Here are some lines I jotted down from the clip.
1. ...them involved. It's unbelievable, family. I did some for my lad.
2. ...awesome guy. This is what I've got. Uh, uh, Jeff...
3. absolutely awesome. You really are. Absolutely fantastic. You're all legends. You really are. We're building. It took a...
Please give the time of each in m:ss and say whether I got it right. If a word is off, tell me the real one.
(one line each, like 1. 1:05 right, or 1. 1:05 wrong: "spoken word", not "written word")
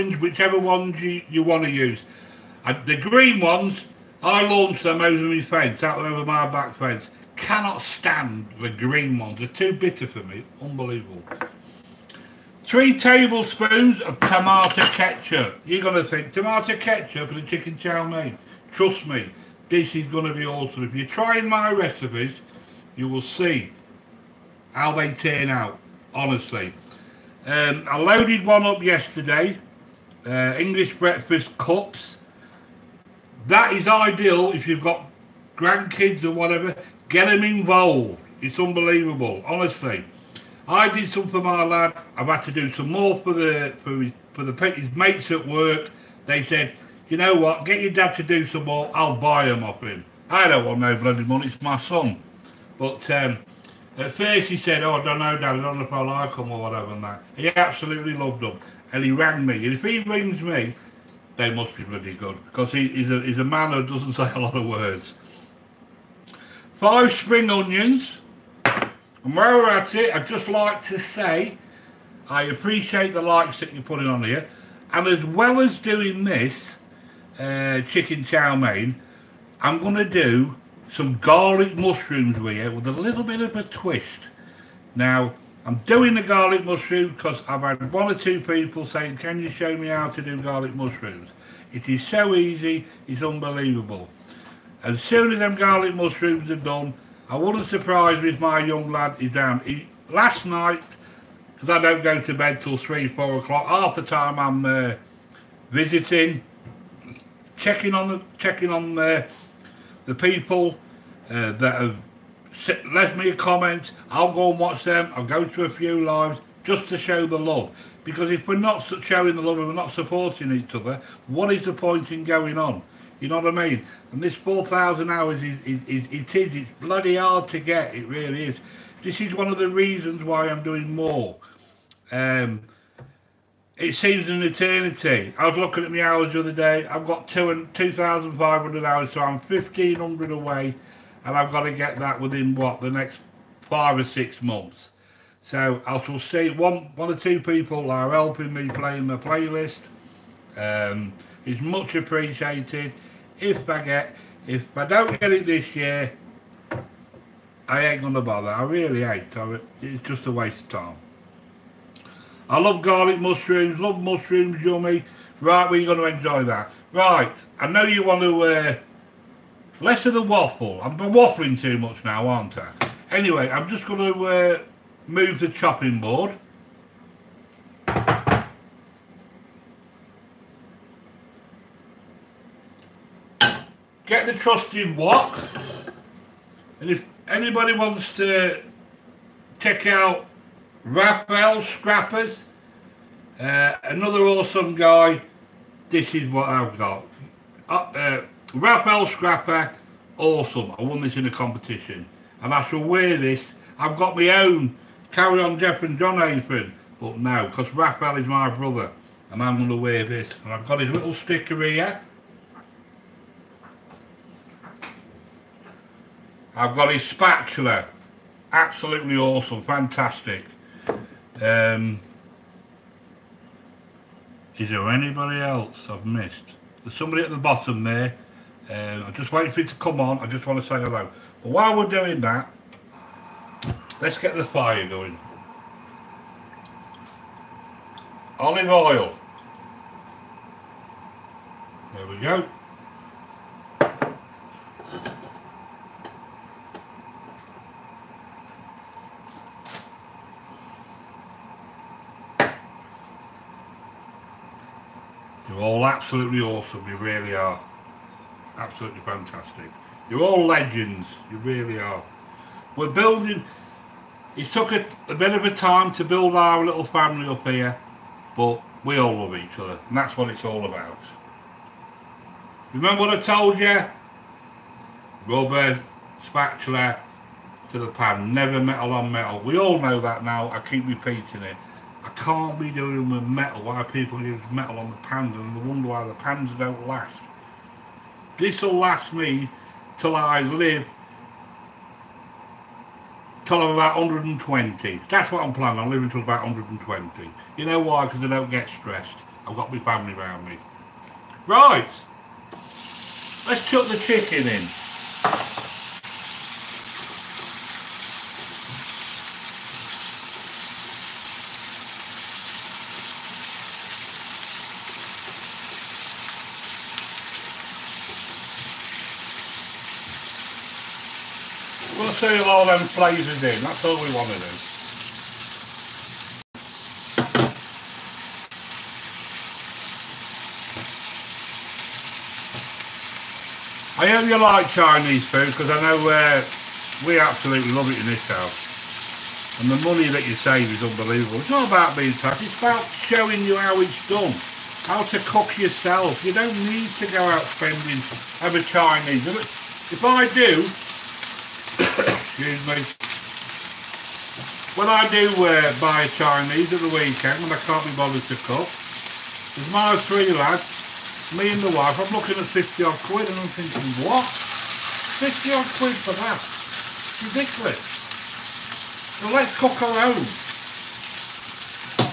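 1. 0:37 wrong: "honestly", not "family"
2. 3:14 wrong: "Raphael", not "Jeff"
3. 4:16 right.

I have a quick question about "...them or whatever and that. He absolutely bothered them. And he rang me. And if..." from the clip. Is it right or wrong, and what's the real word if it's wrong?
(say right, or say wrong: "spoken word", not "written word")
wrong: "loved", not "bothered".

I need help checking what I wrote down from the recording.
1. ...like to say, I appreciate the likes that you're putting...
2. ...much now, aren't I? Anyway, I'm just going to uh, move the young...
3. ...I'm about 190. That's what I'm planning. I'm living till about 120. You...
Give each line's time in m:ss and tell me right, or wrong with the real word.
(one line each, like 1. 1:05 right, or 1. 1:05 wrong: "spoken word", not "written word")
1. 1:10 right
2. 2:51 wrong: "chopping", not "young"
3. 4:53 wrong: "120", not "190".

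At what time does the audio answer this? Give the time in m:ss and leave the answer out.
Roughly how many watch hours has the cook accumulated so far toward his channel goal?
2:17.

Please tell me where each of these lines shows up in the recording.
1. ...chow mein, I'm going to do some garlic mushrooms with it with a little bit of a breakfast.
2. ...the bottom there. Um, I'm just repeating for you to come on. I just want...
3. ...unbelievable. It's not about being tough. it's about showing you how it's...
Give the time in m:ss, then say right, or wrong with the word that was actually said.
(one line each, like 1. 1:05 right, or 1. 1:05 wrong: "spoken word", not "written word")
1. 1:18 wrong: "twist", not "breakfast"
2. 3:47 wrong: "waiting", not "repeating"
3. 5:40 right.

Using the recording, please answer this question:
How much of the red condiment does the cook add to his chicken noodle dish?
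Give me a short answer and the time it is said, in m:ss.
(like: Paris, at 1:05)
3 tablespoons, at 0:12.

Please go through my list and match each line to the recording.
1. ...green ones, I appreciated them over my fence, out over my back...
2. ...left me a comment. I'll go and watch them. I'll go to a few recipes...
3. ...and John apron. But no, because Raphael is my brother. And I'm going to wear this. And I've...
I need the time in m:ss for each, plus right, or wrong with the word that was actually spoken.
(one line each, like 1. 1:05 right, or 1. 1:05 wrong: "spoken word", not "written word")
1. 0:02 wrong: "launched", not "appreciated"
2. 1:52 wrong: "lives", not "recipes"
3. 3:25 right.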